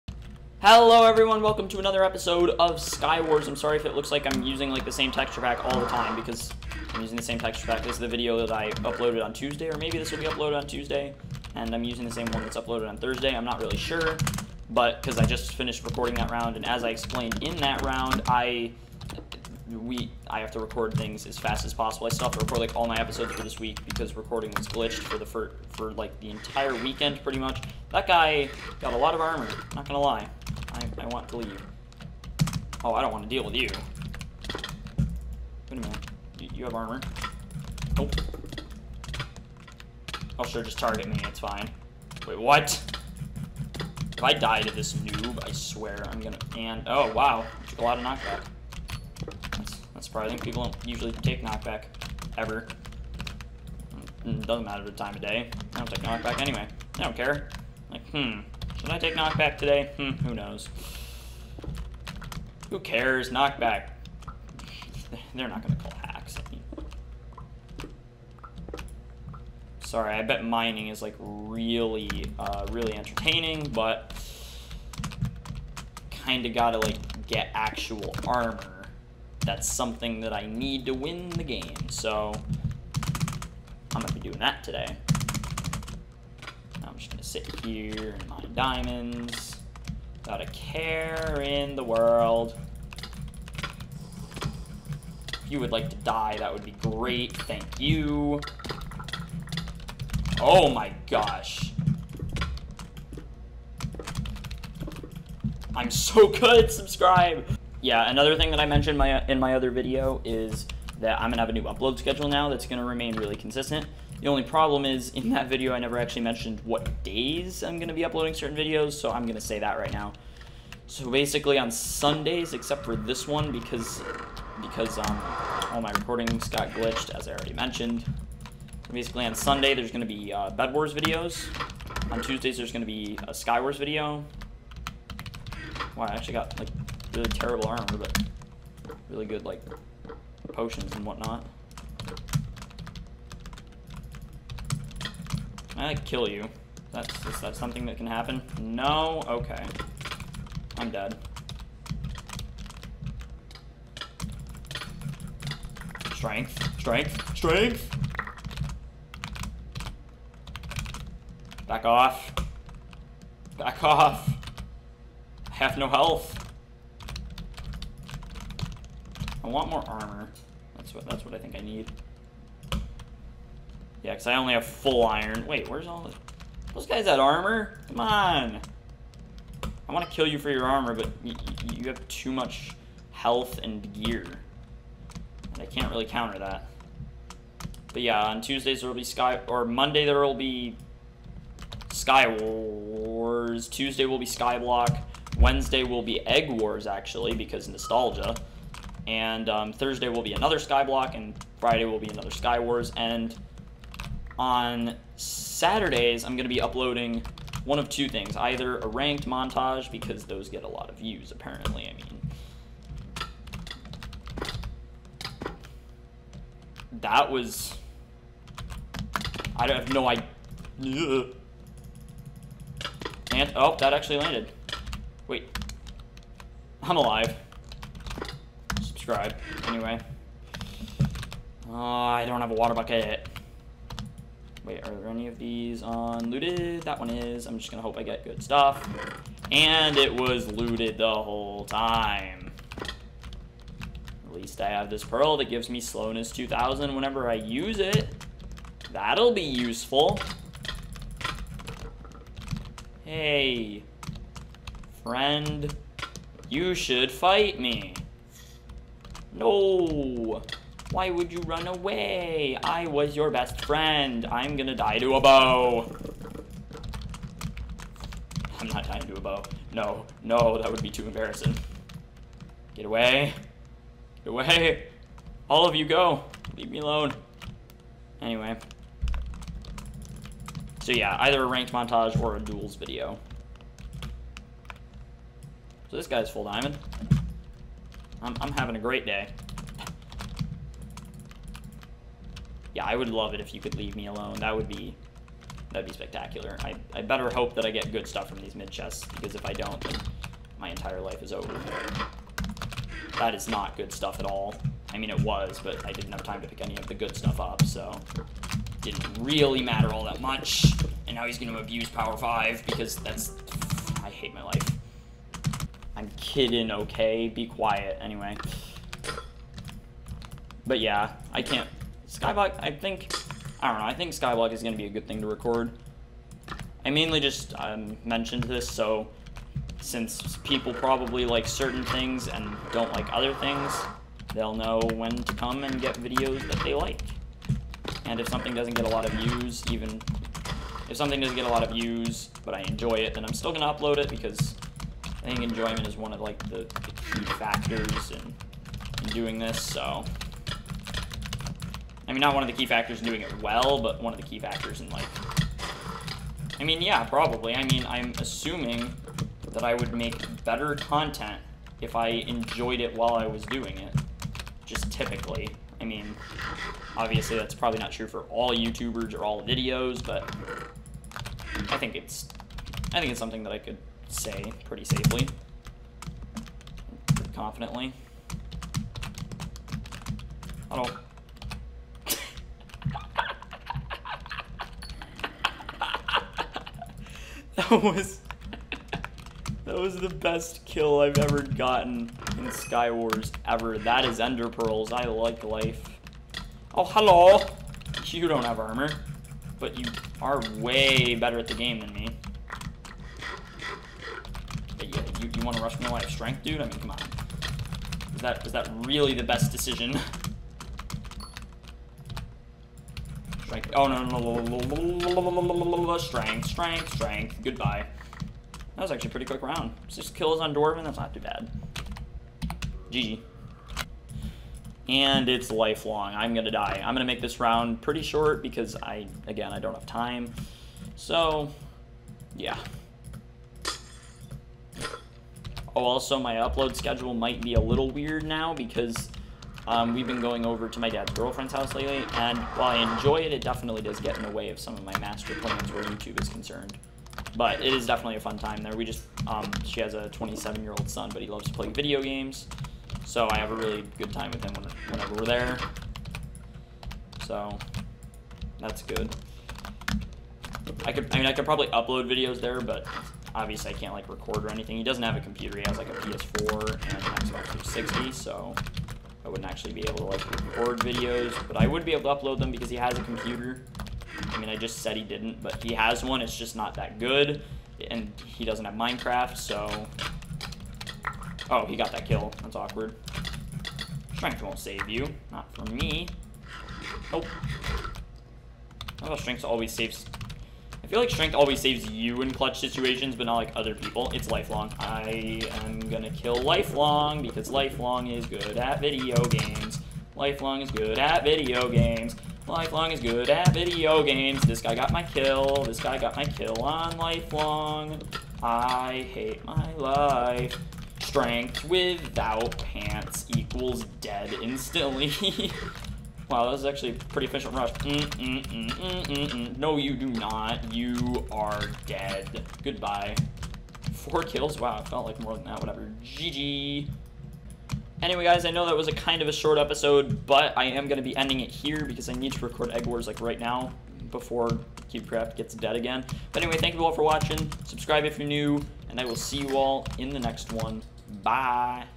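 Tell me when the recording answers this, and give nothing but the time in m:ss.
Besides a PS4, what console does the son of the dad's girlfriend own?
7:46.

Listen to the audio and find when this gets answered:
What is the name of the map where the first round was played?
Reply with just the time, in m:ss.
7:00.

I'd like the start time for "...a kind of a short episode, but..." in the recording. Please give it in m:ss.
8:48.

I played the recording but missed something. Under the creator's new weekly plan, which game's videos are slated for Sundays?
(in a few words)
Bed Wars.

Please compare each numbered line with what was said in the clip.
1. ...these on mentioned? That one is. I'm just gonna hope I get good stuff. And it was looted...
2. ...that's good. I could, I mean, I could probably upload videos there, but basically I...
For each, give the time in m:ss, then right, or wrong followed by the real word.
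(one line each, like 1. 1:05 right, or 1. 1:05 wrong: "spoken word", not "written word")
1. 3:55 wrong: "looted", not "mentioned"
2. 7:38 wrong: "obviously", not "basically".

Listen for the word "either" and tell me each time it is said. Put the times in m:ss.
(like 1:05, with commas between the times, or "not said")
3:28, 4:41.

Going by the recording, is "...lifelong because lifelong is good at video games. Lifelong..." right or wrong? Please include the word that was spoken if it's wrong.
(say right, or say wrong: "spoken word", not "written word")
right.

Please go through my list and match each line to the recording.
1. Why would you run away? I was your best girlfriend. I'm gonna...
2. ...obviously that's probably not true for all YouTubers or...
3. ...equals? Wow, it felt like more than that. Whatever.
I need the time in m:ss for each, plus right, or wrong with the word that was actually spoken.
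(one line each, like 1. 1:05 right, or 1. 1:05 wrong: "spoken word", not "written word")
1. 4:20 wrong: "friend", not "girlfriend"
2. 6:06 right
3. 8:44 wrong: "kills", not "equals".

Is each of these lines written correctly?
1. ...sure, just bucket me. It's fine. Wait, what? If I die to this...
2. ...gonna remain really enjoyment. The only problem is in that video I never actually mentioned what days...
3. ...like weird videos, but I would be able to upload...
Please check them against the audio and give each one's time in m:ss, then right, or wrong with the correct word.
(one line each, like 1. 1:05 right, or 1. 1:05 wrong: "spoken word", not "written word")
1. 0:40 wrong: "target", not "bucket"
2. 1:52 wrong: "consistent", not "enjoyment"
3. 7:50 wrong: "record", not "weird".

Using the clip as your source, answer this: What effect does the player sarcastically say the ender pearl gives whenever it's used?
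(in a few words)
slowness 2000.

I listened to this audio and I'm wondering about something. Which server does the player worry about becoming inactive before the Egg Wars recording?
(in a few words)
CubeCraft.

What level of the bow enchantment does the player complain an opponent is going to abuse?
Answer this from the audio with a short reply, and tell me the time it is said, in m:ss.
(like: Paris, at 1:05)
Power 5, at 5:11.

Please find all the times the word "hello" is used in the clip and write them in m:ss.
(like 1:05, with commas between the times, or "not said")
0:00, 6:36.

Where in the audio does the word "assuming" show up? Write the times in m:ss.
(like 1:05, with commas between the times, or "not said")
5:58.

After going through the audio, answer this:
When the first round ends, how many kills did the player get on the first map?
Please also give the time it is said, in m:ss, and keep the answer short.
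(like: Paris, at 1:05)
6, at 6:59.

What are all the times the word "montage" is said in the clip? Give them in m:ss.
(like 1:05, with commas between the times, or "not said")
3:29, 4:41.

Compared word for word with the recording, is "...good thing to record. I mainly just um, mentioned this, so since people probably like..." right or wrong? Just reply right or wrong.
right.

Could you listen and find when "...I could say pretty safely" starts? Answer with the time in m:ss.
6:13.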